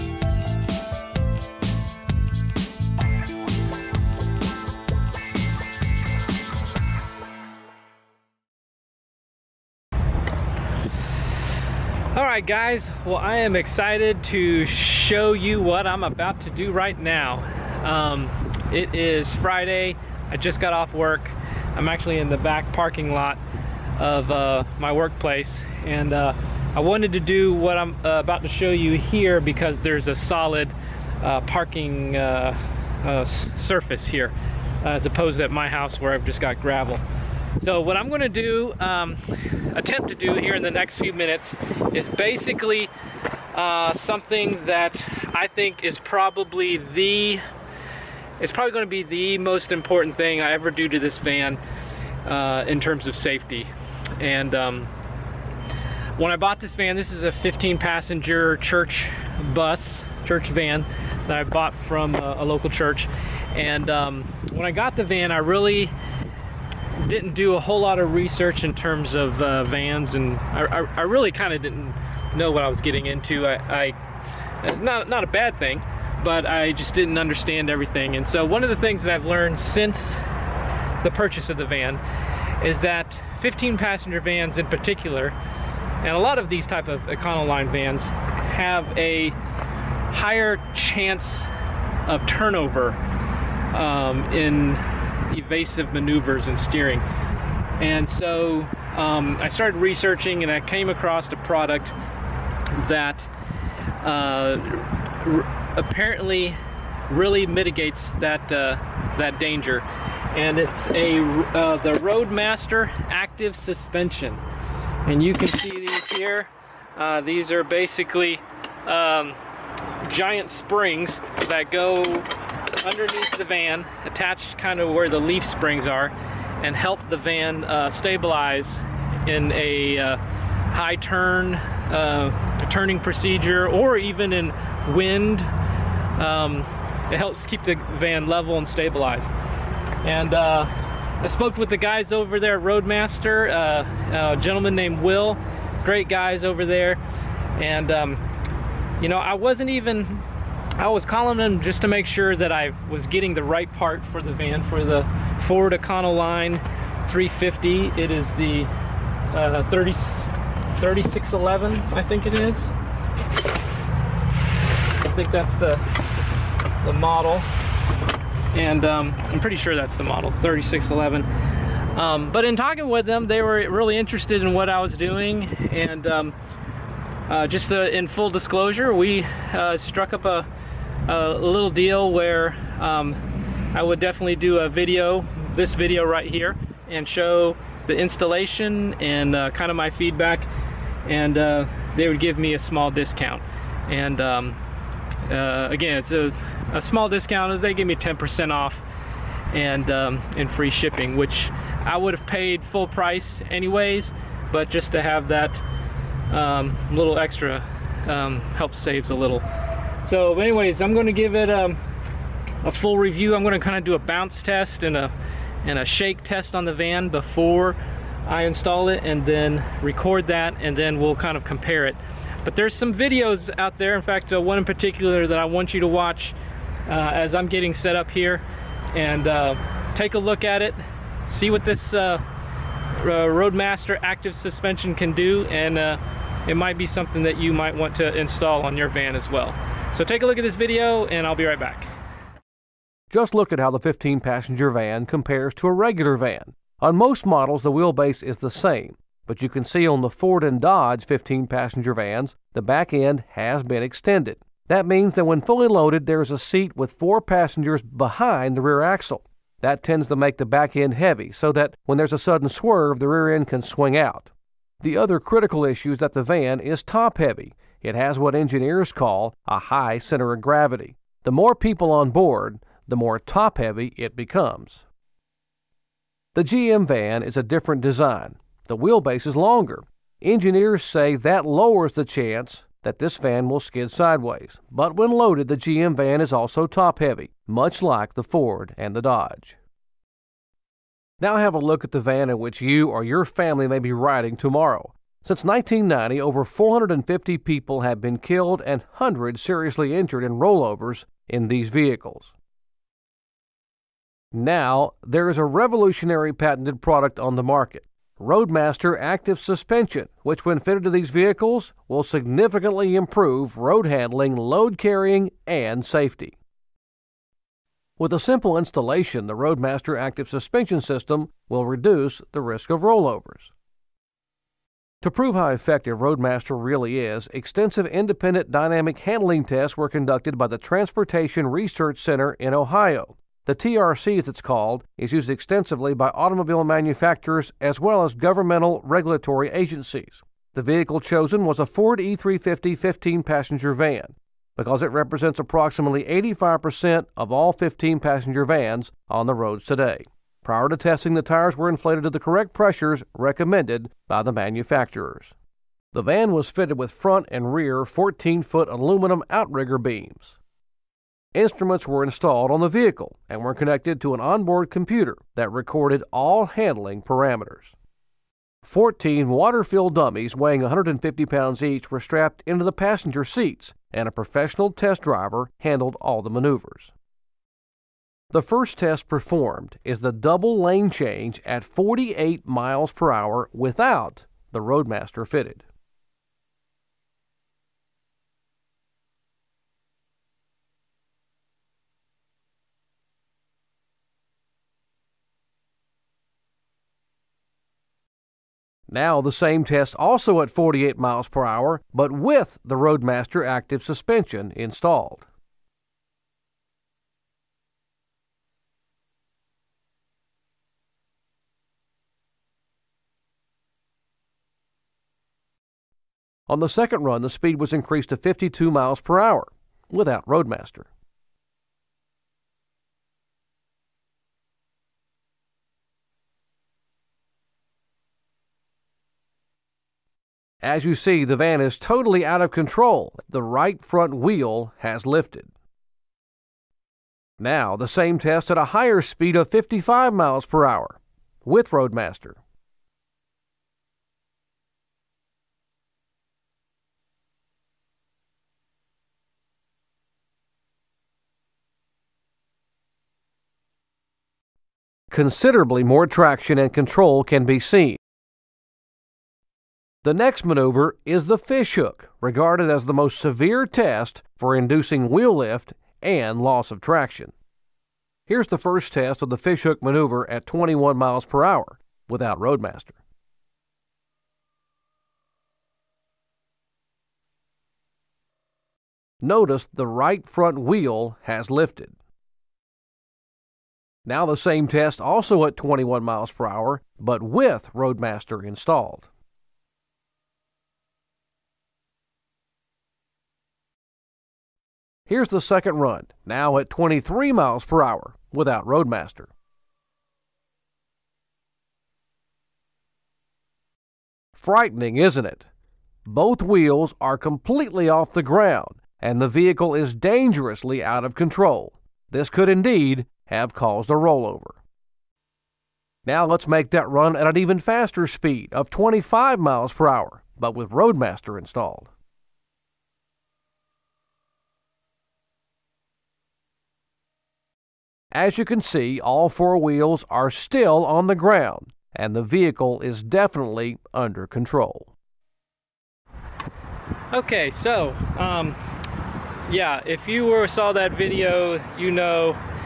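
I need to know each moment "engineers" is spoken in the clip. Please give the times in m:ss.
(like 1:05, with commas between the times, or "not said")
4:28, 4:40.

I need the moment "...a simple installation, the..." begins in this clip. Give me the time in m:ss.
5:18.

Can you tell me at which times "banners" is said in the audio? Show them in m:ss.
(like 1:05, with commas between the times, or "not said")
not said.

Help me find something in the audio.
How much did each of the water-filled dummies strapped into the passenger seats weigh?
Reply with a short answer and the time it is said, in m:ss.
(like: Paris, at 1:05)
150 pounds, at 6:10.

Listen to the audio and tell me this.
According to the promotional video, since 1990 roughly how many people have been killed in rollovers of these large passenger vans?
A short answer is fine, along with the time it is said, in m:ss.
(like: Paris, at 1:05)
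over 450, at 4:56.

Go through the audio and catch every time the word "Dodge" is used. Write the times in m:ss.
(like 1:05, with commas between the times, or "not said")
4:10, 4:49.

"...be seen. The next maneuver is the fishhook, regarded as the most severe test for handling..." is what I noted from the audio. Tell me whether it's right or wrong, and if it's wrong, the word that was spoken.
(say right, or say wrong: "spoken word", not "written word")
wrong: "inducing", not "handling".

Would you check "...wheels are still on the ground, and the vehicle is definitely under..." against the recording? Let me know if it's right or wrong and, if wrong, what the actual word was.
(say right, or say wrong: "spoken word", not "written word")
right.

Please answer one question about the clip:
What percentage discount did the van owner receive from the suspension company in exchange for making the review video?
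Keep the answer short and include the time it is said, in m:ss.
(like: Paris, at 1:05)
10%, at 3:17.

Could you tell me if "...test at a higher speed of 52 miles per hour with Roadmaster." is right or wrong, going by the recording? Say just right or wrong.
wrong.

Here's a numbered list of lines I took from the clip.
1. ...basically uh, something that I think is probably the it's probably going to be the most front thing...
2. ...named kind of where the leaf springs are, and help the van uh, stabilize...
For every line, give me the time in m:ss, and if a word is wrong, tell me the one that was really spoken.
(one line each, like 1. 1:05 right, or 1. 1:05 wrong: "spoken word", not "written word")
1. 0:42 wrong: "important", not "front"
2. 2:04 wrong: "attached", not "named".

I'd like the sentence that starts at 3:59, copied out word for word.
So take a look at this video and I'll be right back.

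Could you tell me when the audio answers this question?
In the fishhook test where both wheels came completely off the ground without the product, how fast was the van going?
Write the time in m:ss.
8:16.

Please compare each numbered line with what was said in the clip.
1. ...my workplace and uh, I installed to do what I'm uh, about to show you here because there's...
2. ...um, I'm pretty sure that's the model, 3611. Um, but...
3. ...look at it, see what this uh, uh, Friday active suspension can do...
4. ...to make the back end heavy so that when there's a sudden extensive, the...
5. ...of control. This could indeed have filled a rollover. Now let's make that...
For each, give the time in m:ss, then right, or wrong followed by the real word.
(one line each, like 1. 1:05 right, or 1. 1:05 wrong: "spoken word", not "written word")
1. 0:24 wrong: "wanted", not "installed"
2. 2:48 right
3. 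3:50 wrong: "Roadmaster", not "Friday"
4. 4:20 wrong: "swerve", not "extensive"
5. 8:31 wrong: "caused", not "filled".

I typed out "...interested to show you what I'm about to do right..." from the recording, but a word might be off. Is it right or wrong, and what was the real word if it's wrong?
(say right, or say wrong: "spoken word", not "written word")
wrong: "excited", not "interested".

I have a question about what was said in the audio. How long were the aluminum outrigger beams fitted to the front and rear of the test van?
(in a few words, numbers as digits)
14 foot.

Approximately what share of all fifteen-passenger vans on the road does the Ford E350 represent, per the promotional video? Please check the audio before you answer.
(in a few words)
85%.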